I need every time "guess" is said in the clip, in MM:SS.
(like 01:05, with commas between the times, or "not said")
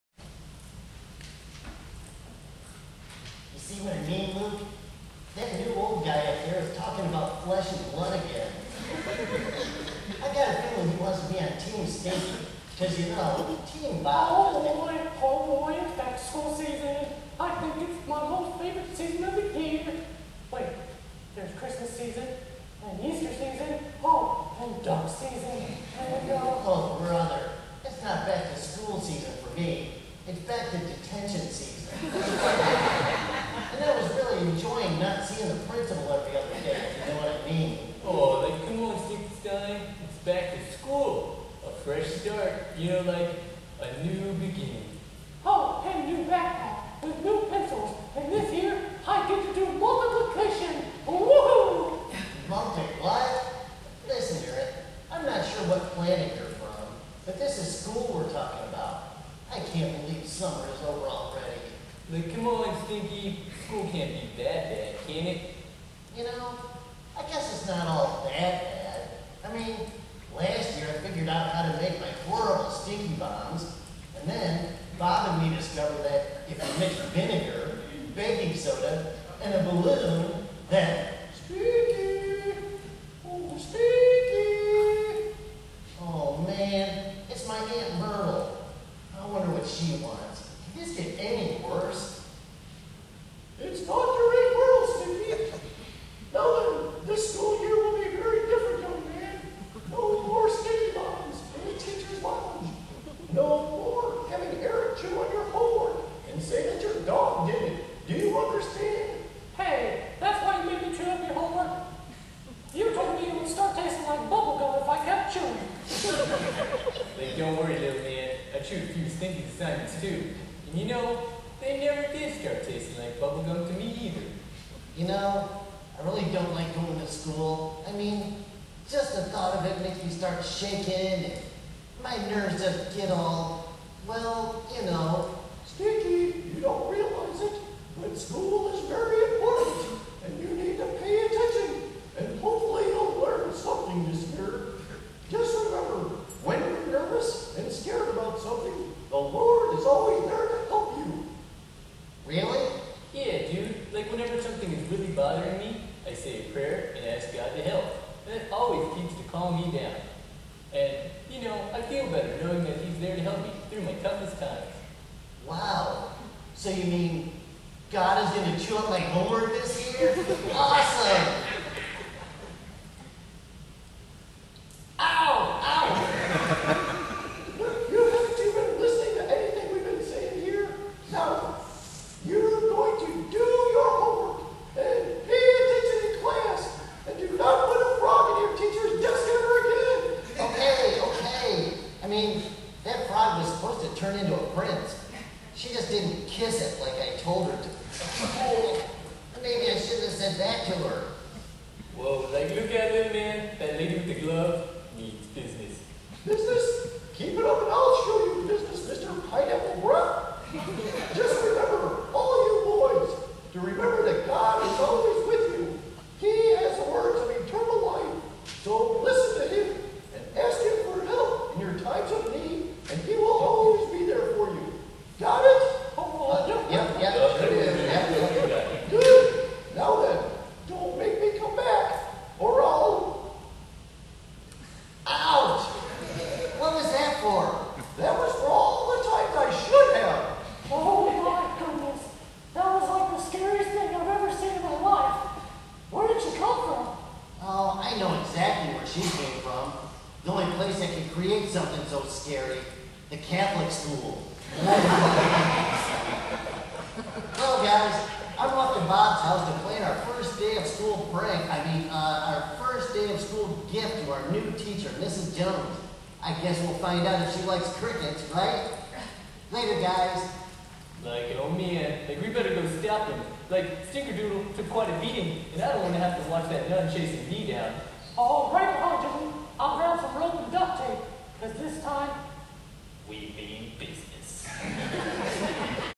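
01:07, 04:26.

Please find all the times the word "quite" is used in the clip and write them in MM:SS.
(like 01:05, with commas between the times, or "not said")
04:34.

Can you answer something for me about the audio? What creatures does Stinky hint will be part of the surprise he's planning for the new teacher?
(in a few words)
crickets.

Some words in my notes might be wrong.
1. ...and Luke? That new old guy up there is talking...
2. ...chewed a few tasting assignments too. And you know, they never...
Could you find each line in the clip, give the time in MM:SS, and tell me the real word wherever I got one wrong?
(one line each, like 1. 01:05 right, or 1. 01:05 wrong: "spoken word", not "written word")
1. 00:03 right
2. 01:58 wrong: "stinking", not "tasting".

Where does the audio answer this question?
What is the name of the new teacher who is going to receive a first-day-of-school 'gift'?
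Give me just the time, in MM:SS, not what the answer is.
04:24.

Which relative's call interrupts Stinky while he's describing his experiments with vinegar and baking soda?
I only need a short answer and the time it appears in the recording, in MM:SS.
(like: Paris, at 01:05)
Aunt Myrtle, at 01:27.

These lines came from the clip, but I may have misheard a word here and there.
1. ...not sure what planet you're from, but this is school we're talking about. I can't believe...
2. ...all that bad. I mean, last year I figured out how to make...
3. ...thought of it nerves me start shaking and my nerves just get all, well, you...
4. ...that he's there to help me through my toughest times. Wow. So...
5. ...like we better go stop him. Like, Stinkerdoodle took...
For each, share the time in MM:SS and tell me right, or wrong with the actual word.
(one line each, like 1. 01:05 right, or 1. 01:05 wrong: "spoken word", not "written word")
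1. 00:55 right
2. 01:07 right
3. 02:09 wrong: "makes", not "nerves"
4. 02:42 right
5. 04:32 right.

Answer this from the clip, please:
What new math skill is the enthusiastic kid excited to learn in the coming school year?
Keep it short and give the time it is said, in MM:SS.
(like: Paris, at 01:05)
multiplication, at 00:49.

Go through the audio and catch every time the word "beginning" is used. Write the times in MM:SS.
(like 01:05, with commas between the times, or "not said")
00:44.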